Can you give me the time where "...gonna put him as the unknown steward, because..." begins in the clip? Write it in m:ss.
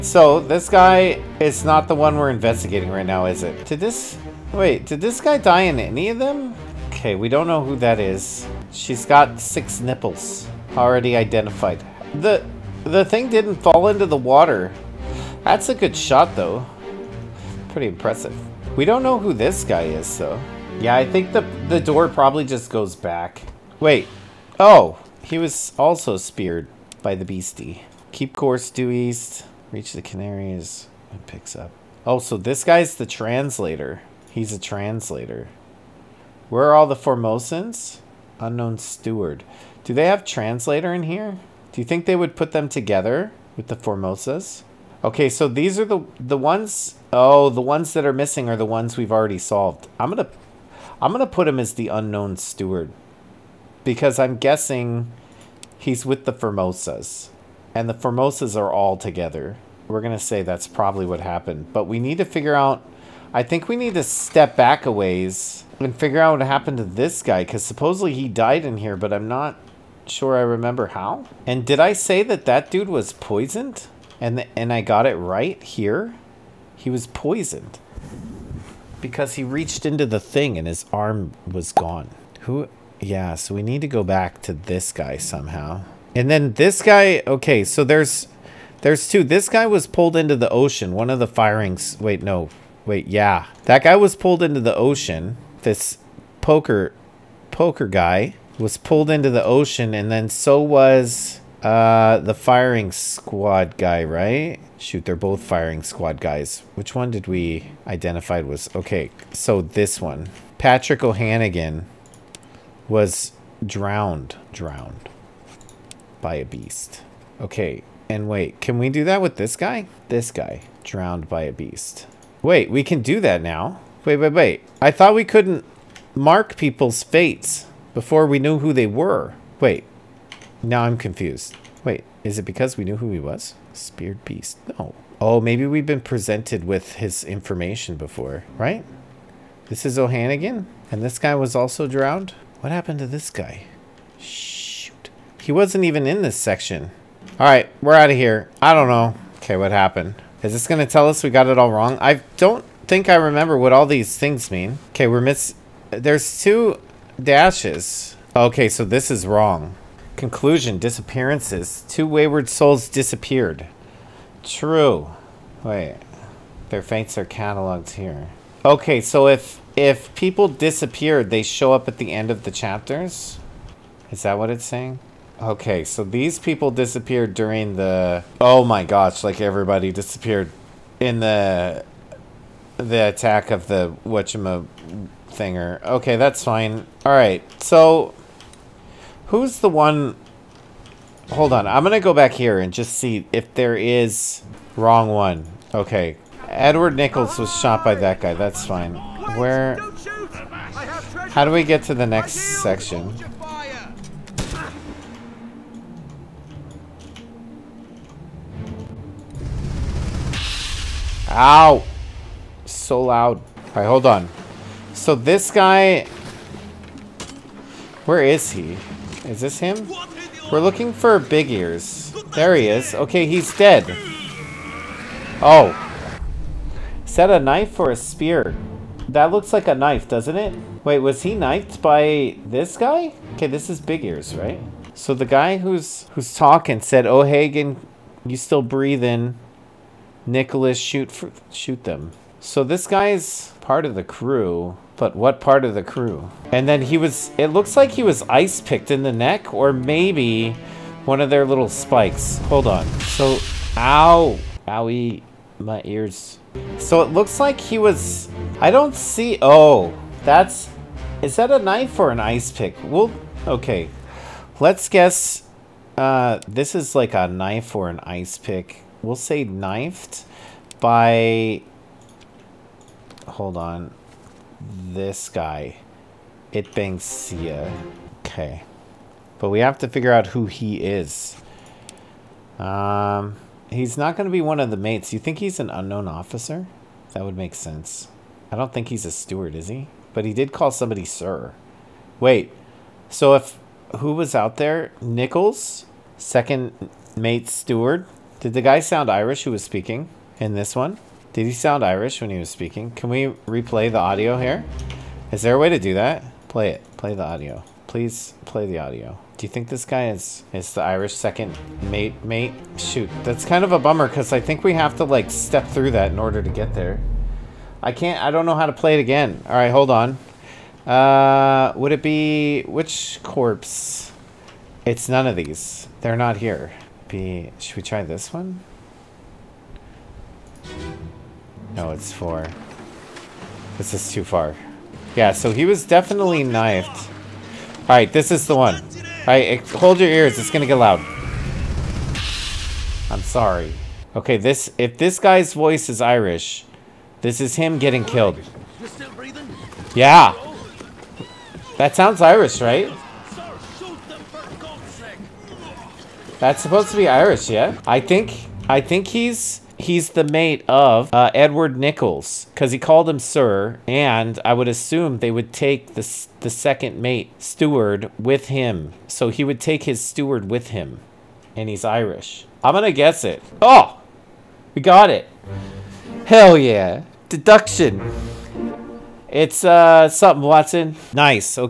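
0:51.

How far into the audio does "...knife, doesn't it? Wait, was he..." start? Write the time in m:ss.
3:49.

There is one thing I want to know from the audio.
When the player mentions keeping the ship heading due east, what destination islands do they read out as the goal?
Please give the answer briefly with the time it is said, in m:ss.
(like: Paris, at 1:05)
Canaries, at 0:30.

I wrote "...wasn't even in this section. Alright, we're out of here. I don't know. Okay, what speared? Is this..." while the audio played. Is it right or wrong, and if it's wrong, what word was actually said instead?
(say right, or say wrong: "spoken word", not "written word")
wrong: "happened", not "speared".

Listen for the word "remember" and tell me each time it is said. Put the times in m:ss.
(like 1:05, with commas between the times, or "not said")
1:10, 2:33.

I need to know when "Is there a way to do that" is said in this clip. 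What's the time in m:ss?
5:05.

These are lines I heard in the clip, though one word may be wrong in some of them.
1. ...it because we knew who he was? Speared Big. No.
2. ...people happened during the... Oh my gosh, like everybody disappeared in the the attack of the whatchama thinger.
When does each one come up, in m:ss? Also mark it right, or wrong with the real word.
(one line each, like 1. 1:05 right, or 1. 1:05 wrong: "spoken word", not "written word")
1. 2:12 wrong: "Beast", not "Big"
2. 2:56 wrong: "disappeared", not "happened".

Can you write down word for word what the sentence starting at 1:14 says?
And and I got it right here.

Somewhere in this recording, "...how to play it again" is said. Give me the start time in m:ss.
5:18.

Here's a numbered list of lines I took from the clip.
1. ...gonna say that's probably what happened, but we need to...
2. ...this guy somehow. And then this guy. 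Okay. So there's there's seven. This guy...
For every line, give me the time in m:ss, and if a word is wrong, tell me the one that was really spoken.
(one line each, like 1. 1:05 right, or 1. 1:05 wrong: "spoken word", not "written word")
1. 0:59 right
2. 1:24 wrong: "two", not "seven".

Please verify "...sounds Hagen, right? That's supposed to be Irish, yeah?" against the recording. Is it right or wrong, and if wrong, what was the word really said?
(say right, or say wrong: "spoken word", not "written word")
wrong: "Irish", not "Hagen".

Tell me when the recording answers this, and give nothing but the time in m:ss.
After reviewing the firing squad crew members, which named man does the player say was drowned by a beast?
1:50.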